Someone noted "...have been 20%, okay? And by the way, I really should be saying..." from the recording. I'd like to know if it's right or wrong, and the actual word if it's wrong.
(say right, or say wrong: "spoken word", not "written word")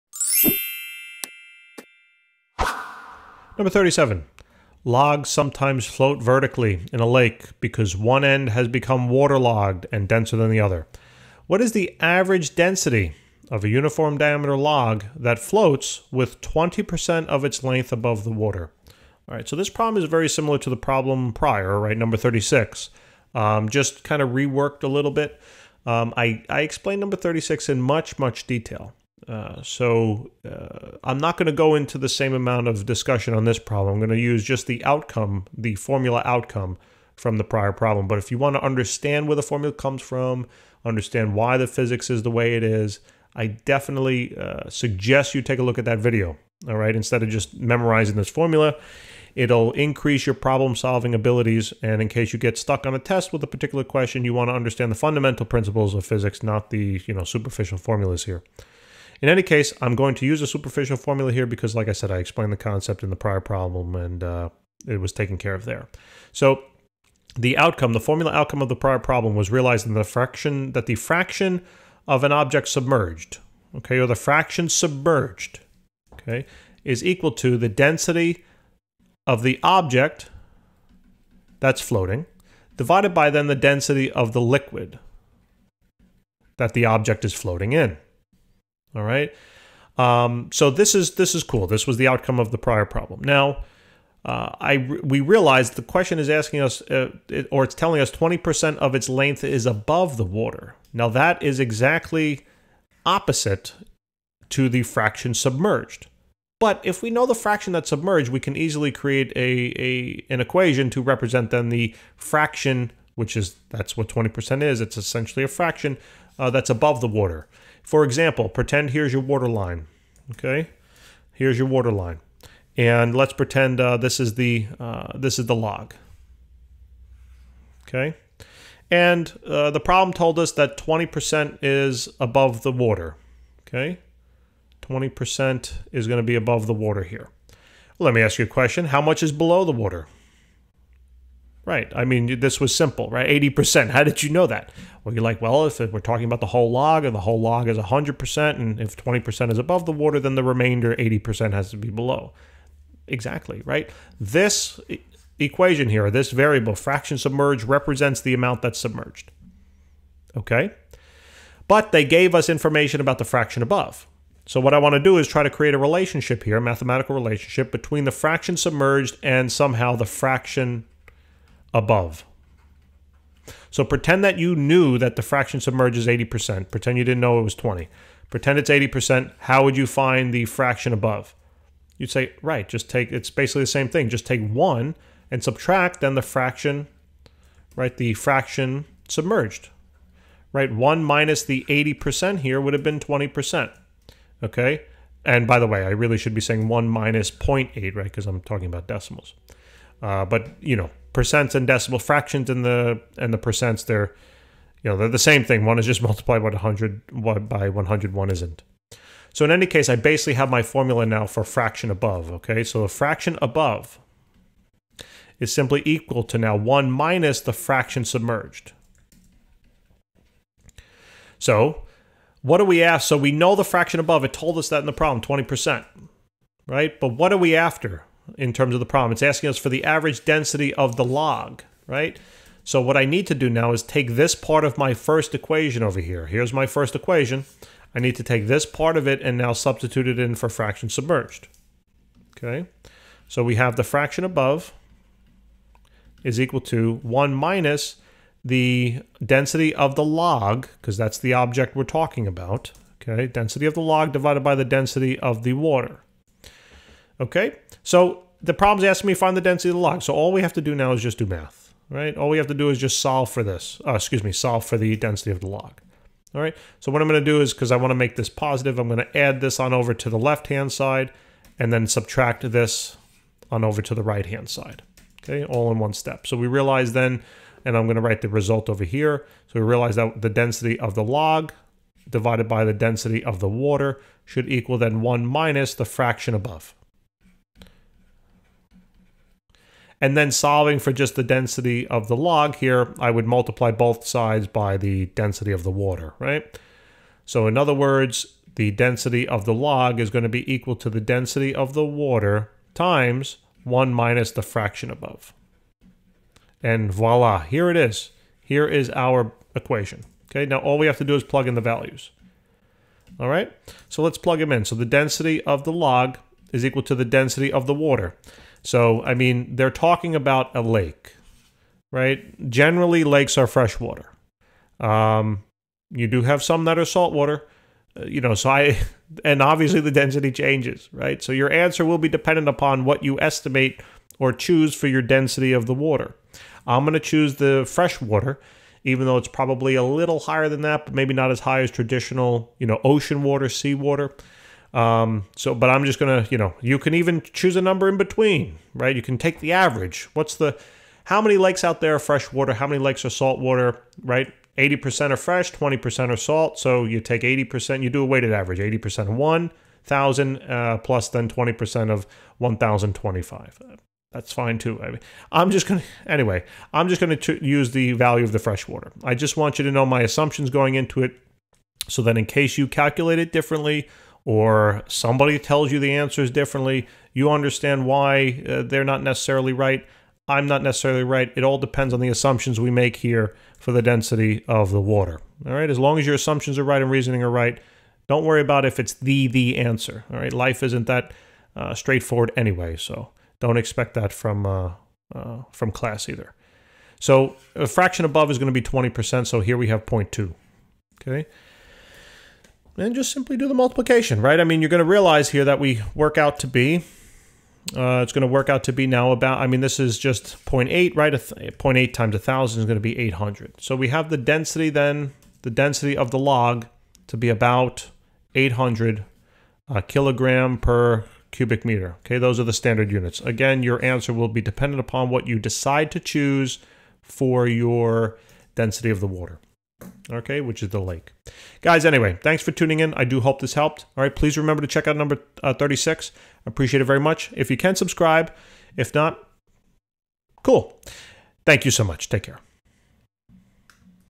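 right.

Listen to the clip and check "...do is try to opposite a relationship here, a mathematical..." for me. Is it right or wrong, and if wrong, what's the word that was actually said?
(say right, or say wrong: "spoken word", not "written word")
wrong: "create", not "opposite".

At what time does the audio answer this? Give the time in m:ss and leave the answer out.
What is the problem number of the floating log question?
0:03.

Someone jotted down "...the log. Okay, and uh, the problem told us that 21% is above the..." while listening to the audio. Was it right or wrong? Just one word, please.
wrong.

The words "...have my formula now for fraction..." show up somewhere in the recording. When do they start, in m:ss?
3:30.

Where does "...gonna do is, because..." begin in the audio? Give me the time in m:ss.
4:27.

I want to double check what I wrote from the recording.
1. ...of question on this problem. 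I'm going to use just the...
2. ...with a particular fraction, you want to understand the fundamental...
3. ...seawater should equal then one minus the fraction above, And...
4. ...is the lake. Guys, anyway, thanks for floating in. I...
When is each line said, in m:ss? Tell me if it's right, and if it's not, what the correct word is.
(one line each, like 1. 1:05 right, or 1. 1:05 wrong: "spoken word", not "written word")
1. 0:32 wrong: "discussion", not "question"
2. 0:53 wrong: "question", not "fraction"
3. 4:43 wrong: "water", not "seawater"
4. 7:10 wrong: "tuning", not "floating".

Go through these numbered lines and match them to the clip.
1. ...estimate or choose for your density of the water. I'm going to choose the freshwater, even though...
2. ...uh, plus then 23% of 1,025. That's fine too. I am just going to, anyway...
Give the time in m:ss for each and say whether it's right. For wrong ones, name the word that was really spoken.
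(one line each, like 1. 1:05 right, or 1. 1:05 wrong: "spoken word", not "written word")
1. 5:33 right
2. 6:00 wrong: "20", not "23".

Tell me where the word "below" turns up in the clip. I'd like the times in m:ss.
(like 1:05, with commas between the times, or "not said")
2:19, 2:31.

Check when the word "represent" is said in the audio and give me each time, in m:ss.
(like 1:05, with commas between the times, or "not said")
1:51, 2:37.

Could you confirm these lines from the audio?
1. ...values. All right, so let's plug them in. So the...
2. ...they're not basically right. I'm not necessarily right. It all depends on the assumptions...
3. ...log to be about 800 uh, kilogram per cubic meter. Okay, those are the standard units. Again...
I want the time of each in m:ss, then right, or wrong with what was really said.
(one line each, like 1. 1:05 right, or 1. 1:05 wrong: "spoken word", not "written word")
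1. 5:11 right
2. 6:18 wrong: "necessarily", not "basically"
3. 6:56 right.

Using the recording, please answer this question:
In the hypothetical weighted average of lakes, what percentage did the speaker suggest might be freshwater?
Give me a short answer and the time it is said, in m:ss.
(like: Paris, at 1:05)
80%, at 5:54.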